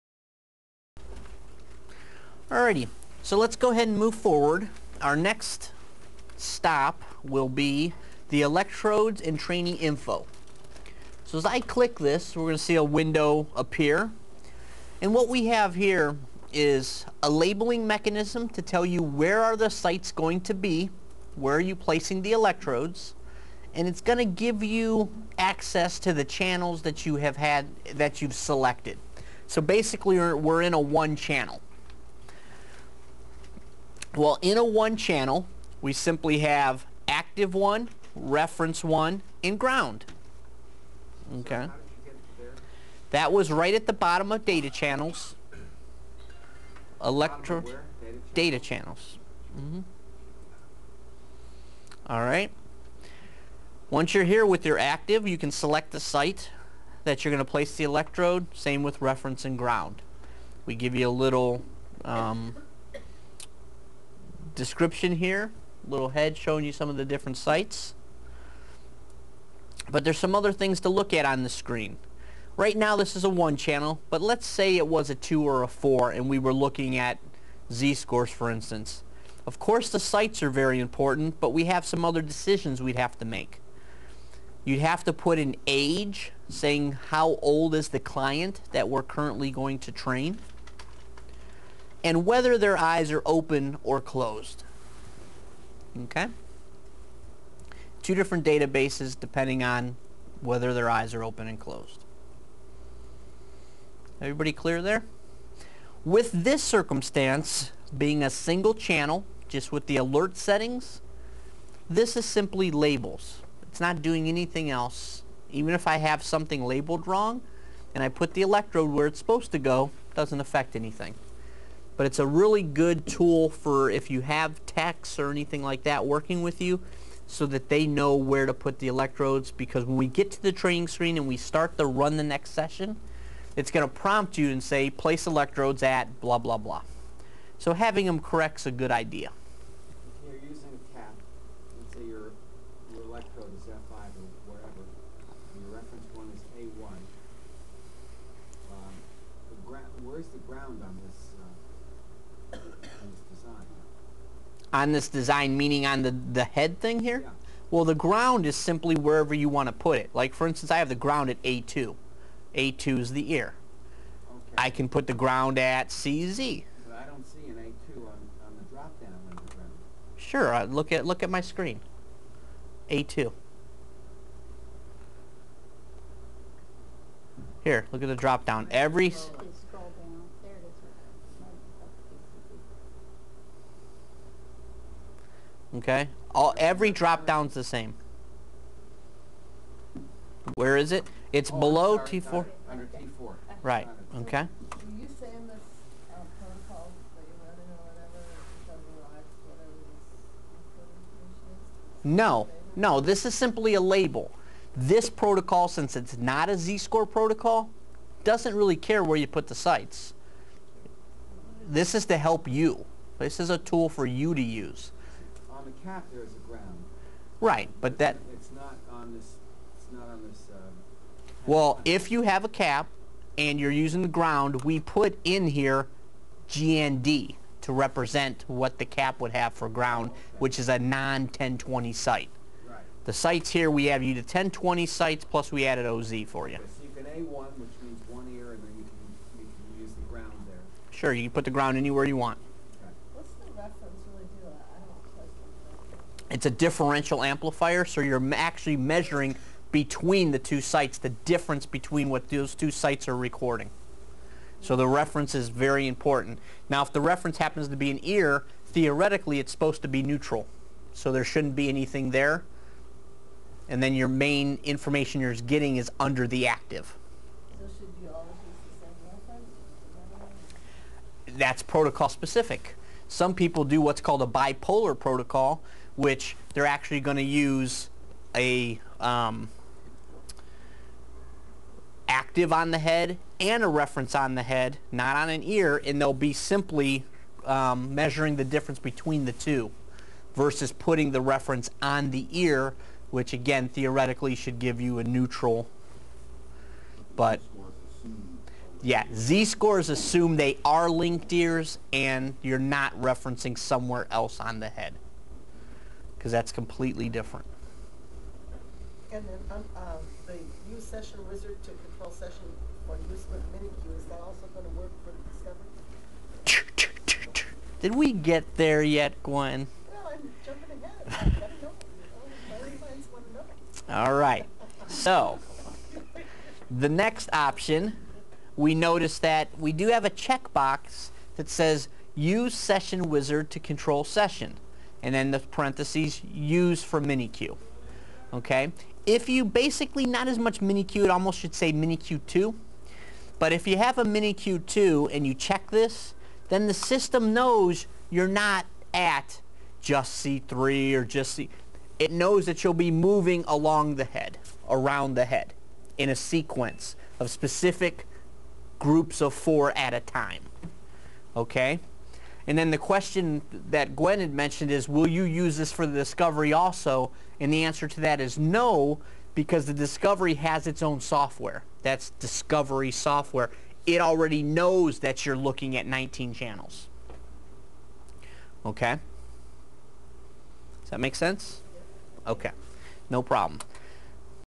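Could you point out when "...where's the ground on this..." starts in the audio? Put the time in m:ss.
2:30.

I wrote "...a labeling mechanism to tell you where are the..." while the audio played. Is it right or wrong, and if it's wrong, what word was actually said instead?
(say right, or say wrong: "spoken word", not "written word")
right.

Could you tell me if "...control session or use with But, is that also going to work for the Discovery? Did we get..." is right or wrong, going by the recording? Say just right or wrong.
wrong.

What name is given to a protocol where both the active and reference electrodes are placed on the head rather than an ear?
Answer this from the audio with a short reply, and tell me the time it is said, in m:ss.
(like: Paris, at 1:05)
bipolar protocol, at 4:34.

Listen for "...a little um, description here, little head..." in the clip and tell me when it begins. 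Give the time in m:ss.
1:01.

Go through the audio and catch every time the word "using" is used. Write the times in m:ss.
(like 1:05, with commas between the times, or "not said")
2:20, 3:43.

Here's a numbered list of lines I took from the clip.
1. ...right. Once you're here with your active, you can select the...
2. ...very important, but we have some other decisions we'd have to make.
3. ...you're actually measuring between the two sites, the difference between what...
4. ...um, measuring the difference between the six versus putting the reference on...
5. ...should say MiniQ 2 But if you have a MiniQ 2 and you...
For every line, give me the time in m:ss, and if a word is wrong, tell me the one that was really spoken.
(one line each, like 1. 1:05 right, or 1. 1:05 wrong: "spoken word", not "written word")
1. 0:52 right
2. 1:20 right
3. 4:08 right
4. 4:47 wrong: "two", not "six"
5. 5:41 right.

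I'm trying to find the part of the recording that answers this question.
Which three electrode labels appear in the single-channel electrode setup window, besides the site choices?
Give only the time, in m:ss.
0:37.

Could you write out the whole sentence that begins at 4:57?
But yeah, z-scores assume they are linked ears and you're not referencing somewhere else on the head because that's completely different.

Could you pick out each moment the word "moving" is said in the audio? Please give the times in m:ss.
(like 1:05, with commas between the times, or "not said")
5:52.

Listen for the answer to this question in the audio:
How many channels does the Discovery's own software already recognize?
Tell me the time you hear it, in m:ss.
6:15.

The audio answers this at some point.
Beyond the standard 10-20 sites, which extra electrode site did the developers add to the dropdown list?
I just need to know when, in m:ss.
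3:55.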